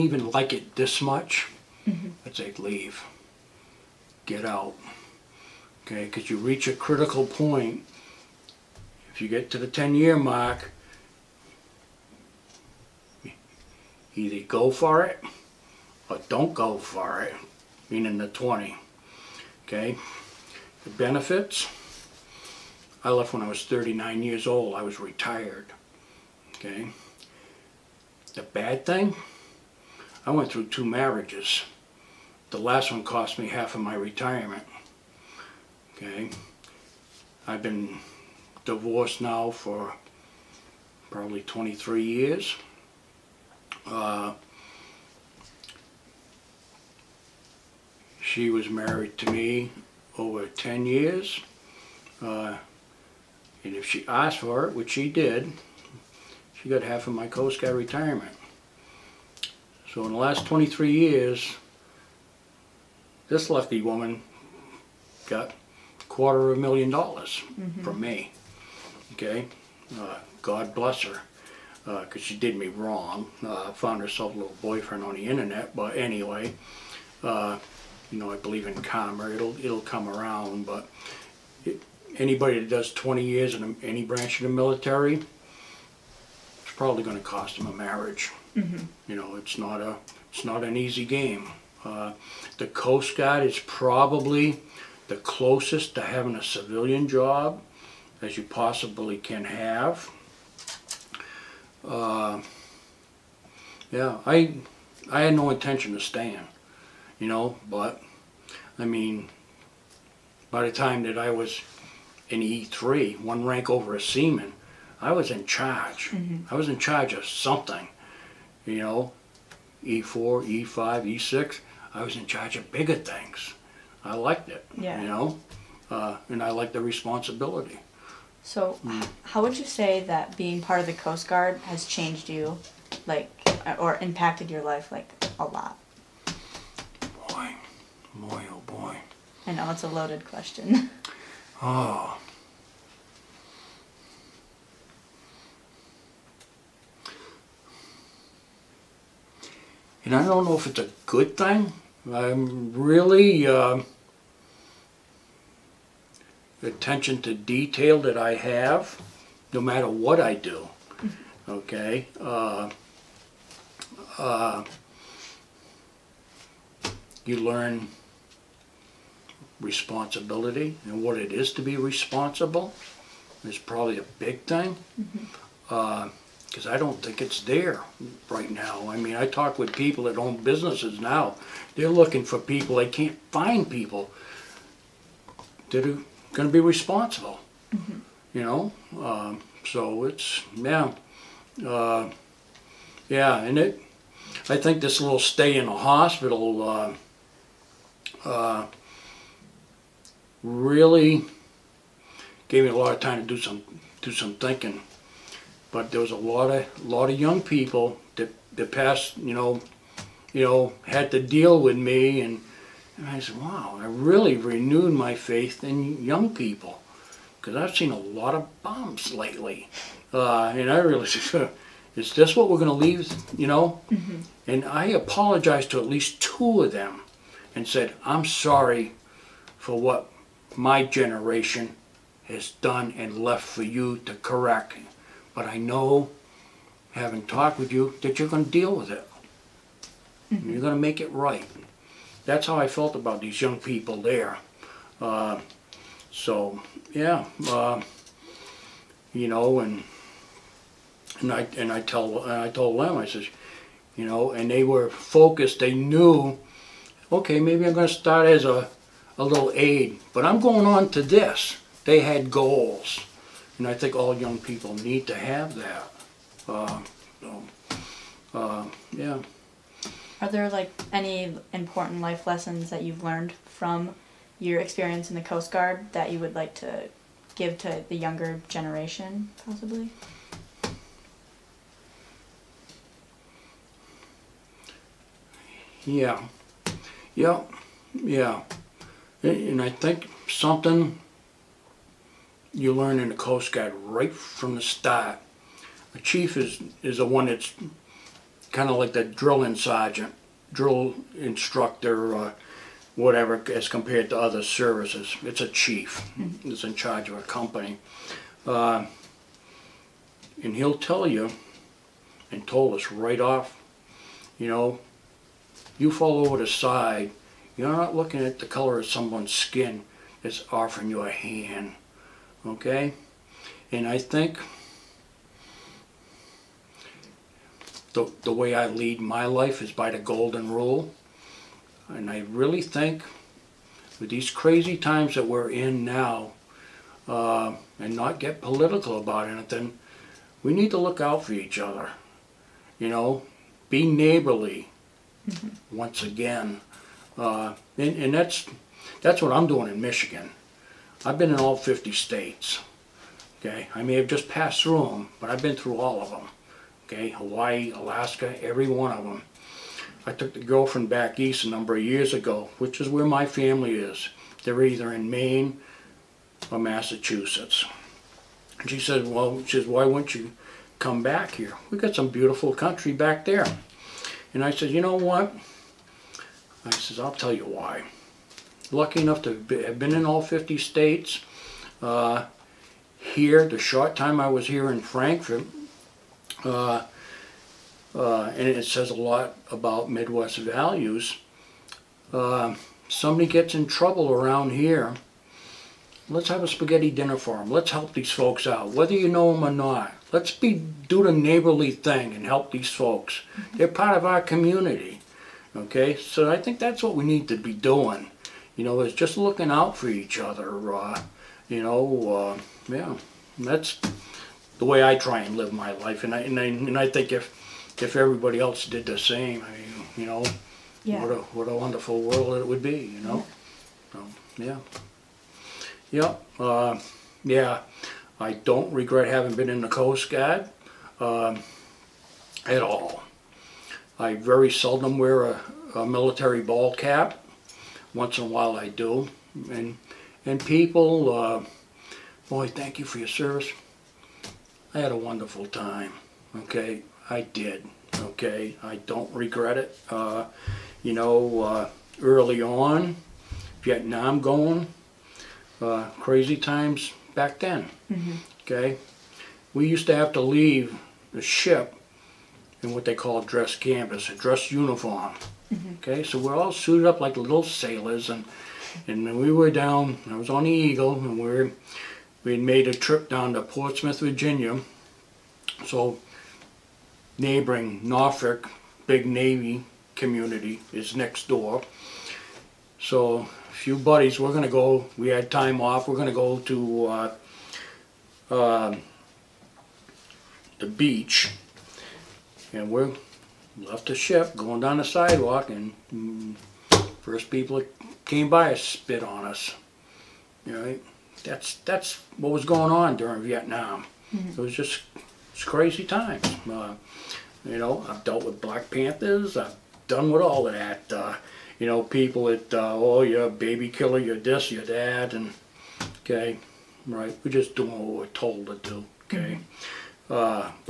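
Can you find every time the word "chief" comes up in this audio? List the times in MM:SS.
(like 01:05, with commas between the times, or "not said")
04:55, 05:05.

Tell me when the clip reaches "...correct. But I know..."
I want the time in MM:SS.
03:54.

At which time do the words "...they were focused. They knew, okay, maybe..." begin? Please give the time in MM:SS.
04:14.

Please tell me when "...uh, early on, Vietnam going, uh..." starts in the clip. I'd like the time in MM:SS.
07:31.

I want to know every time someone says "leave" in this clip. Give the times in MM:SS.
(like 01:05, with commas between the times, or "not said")
00:02, 03:42, 07:40.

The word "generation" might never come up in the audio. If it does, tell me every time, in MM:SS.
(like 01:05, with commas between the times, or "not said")
03:50, 04:38.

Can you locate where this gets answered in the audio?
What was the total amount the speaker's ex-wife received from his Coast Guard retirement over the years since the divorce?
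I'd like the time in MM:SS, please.
01:05.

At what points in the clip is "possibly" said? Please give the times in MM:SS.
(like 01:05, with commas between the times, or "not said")
01:38, 04:39.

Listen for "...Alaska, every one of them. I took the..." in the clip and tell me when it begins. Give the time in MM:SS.
05:57.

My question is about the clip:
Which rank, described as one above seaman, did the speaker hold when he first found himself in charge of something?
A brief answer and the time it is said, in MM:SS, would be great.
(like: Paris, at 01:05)
E3, at 01:52.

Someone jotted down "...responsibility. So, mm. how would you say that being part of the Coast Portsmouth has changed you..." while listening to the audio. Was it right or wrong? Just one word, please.
wrong.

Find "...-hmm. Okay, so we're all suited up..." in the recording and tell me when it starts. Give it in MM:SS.
07:45.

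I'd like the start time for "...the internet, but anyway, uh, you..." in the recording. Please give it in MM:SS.
01:15.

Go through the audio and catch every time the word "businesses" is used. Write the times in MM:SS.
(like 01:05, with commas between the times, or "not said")
03:00.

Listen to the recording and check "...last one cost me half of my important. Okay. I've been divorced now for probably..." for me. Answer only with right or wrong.
wrong.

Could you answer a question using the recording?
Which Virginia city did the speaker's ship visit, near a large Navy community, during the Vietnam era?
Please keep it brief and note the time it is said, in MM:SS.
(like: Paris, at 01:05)
Portsmouth, at 07:53.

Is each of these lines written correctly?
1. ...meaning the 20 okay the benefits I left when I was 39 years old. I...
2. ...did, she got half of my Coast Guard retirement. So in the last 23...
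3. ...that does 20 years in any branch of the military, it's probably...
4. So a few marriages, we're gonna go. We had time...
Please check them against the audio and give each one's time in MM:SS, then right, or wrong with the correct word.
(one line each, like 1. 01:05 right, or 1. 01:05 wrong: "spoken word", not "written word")
1. 00:17 right
2. 00:55 right
3. 01:22 right
4. 08:02 wrong: "buddies", not "marriages".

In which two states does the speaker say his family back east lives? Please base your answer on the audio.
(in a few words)
Maine or Massachusetts.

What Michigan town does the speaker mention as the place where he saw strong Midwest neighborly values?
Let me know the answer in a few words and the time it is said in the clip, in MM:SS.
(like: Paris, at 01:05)
Frankfort, at 06:24.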